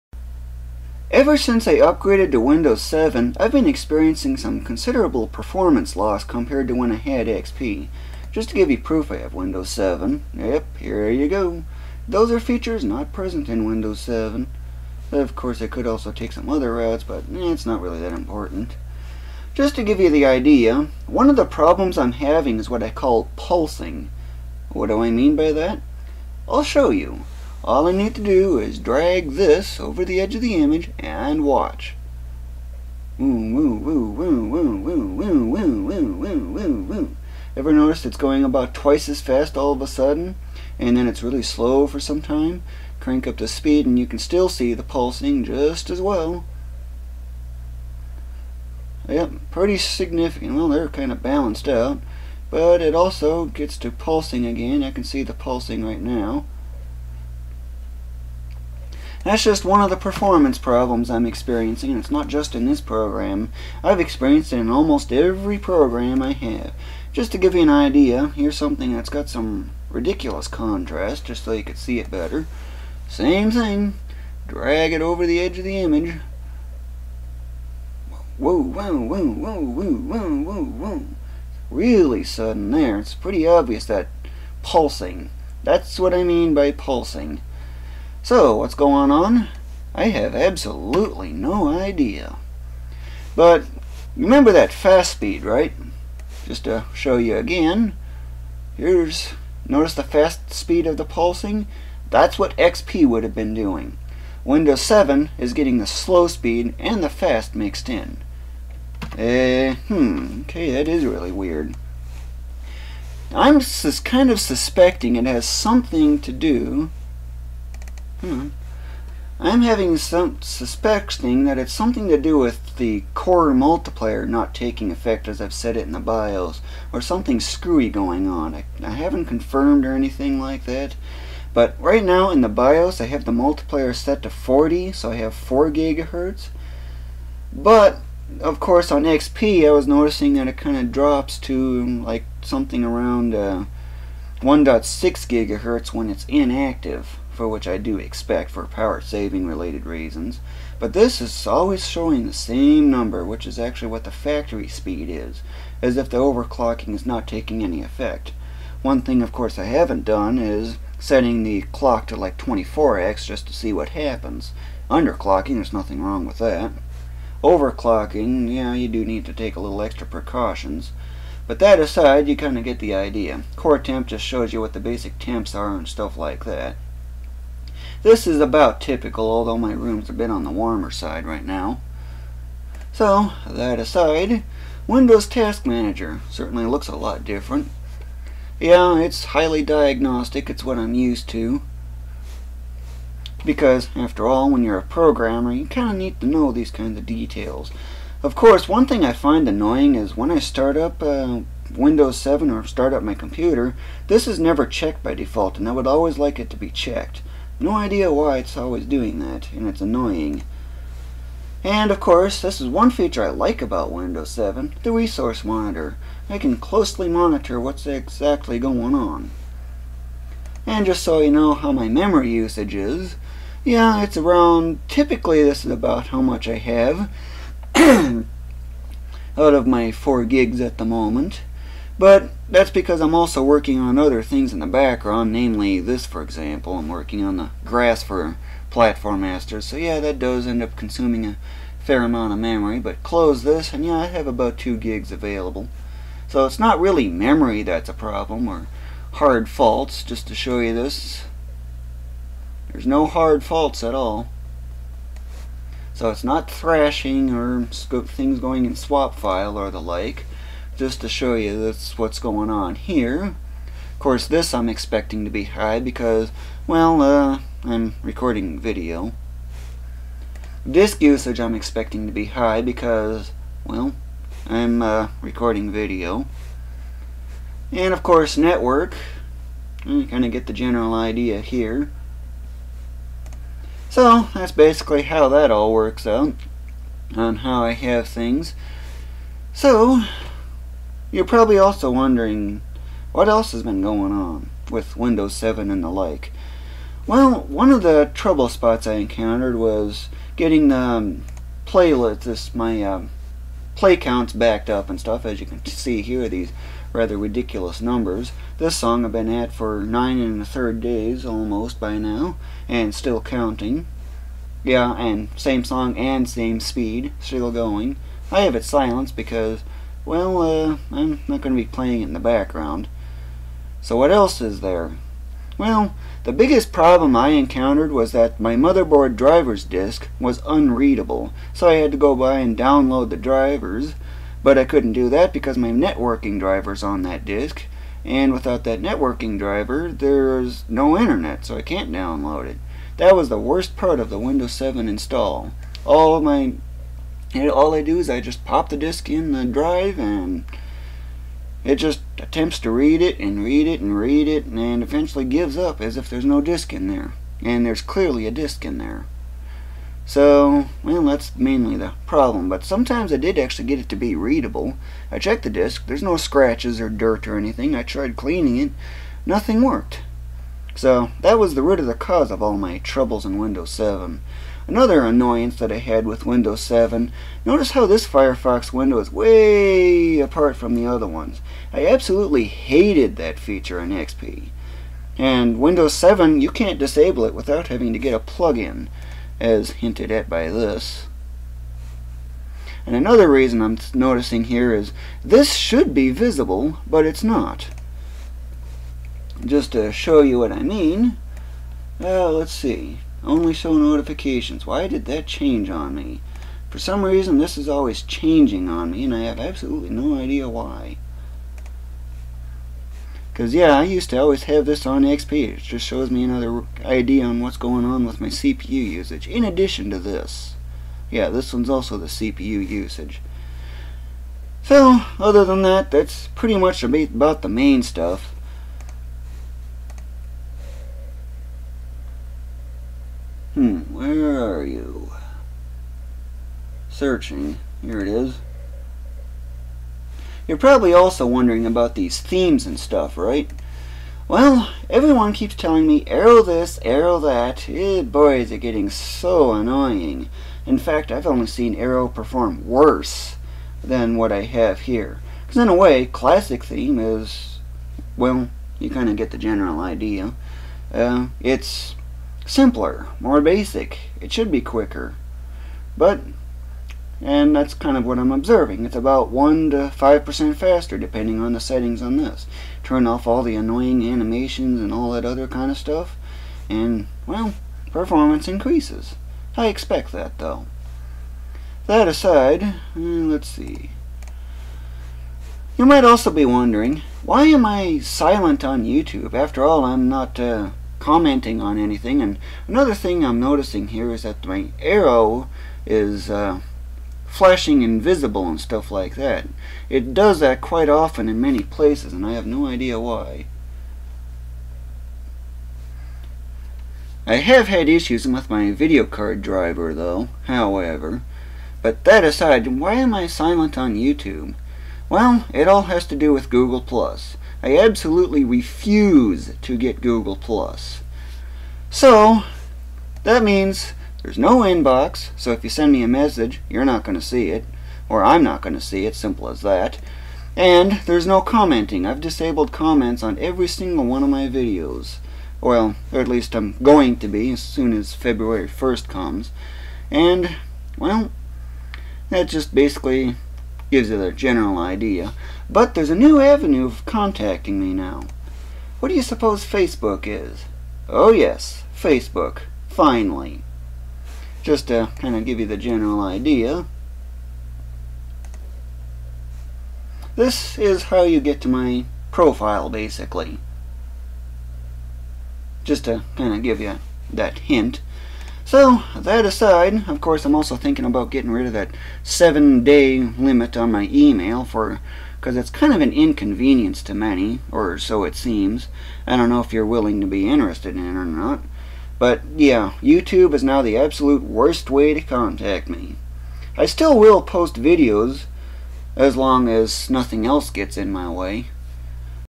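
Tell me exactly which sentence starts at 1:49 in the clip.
Uh, hmm, okay, that is really weird.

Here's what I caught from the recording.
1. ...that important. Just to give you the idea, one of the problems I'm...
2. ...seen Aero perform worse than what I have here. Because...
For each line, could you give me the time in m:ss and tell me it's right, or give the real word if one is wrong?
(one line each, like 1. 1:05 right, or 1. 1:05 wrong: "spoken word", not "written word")
1. 0:17 right
2. 7:31 right.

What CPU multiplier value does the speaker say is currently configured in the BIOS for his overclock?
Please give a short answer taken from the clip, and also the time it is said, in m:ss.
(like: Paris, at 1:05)
40, at 2:14.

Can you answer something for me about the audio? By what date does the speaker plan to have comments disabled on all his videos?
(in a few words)
February 1st.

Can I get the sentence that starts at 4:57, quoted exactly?
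Well, one of the trouble spots I encountered was getting the um, playlist, this, my um, play counts backed up and stuff.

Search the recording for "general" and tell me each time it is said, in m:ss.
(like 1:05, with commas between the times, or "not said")
4:40, 7:39, 9:04, 9:15.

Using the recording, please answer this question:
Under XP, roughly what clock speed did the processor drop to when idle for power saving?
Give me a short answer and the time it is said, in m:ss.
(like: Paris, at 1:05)
1.6 gigahertz, at 2:24.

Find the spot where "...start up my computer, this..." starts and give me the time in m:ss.
3:22.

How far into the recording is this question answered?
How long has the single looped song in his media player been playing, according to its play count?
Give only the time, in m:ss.
5:09.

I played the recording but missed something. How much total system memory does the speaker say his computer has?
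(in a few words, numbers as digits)
4 gigs.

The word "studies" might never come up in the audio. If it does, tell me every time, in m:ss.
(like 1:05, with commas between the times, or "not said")
not said.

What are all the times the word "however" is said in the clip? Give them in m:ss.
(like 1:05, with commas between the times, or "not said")
8:30.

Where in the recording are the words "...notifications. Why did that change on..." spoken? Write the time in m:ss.
6:43.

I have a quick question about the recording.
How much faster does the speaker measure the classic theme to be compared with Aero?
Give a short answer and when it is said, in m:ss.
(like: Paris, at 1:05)
1 to 5%, at 7:49.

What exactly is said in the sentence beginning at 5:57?
And there's clearly a disk in there.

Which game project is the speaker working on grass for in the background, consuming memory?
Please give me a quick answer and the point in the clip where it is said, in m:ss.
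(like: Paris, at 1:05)
Platform Masters, at 3:58.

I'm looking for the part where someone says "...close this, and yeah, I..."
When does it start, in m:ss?
4:03.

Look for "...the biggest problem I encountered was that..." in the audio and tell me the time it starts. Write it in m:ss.
5:26.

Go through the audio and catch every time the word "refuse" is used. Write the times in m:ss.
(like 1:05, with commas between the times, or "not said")
8:38.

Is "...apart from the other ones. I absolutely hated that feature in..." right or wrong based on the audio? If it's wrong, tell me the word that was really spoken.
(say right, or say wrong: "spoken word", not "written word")
right.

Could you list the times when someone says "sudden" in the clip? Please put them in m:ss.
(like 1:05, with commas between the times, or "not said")
0:39, 1:22.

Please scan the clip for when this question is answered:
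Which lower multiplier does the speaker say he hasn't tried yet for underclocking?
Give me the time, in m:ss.
2:42.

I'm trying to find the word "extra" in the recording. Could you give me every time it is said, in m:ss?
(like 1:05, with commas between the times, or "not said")
2:49.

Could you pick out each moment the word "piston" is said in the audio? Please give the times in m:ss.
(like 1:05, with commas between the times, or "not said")
not said.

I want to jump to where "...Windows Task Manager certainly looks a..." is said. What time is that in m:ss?
3:04.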